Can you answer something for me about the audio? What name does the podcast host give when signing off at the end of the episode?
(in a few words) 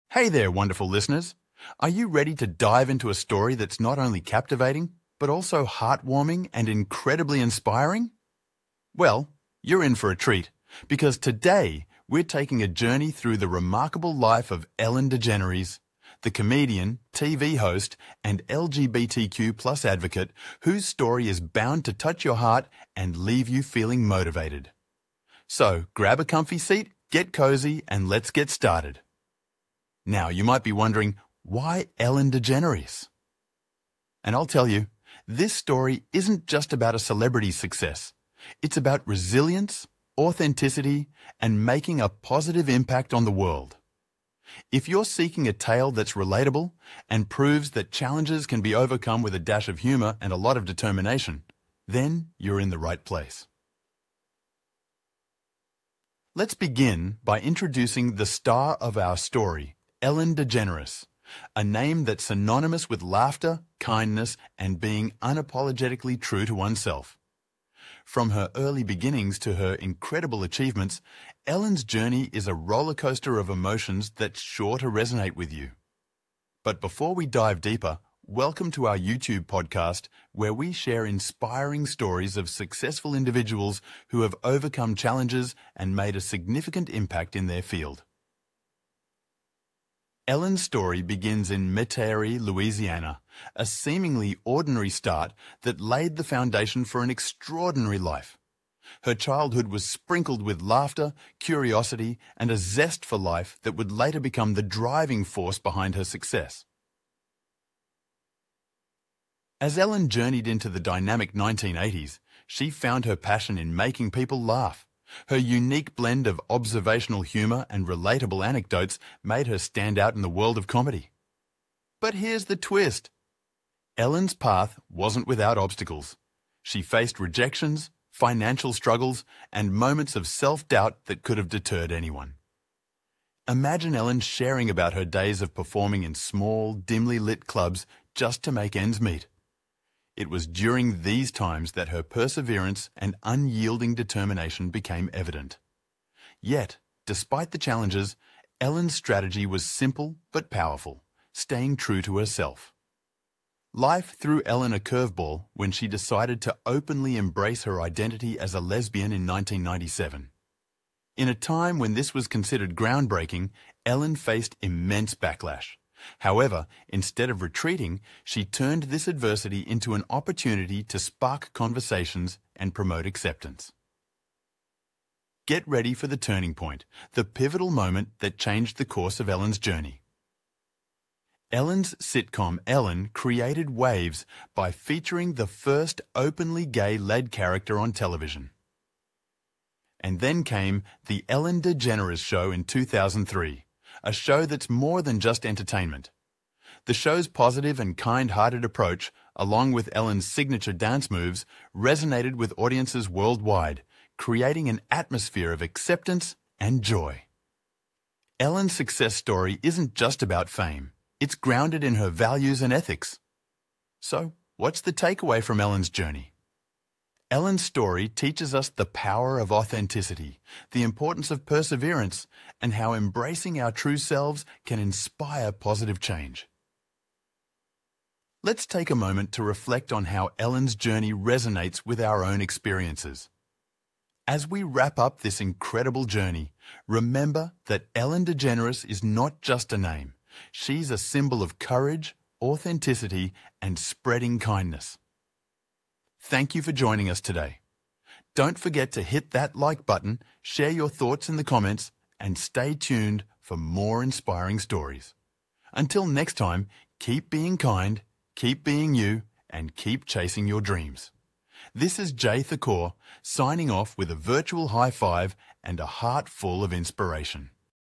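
Jay Thakor.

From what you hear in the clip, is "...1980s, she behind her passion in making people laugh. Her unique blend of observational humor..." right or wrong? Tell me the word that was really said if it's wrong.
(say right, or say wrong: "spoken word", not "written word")
wrong: "found", not "behind".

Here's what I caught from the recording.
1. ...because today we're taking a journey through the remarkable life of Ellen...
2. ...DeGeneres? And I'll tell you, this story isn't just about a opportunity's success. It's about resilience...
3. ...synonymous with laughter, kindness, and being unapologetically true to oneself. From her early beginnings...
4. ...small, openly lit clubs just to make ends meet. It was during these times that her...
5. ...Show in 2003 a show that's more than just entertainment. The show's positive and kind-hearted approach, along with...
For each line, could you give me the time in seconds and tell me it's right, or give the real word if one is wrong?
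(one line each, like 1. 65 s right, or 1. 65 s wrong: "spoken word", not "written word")
1. 10 s right
2. 32 s wrong: "celebrity", not "opportunity"
3. 62 s right
4. 136 s wrong: "dimly", not "openly"
5. 192 s right.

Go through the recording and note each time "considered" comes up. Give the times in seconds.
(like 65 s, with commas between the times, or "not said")
162 s.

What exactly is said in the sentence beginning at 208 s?
Ellen's success story isn't just about fame.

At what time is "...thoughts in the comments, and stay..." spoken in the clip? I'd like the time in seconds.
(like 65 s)
250 s.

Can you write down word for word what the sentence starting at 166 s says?
However, instead of retreating, she turned this adversity into an opportunity to spark conversations and promote acceptance.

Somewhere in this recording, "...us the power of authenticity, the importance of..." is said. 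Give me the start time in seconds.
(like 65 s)
218 s.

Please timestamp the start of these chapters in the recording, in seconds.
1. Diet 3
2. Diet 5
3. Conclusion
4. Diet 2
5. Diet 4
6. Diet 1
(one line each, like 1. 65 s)
1. 96 s
2. 153 s
3. 180 s
4. 64 s
5. 124 s
6. 30 s.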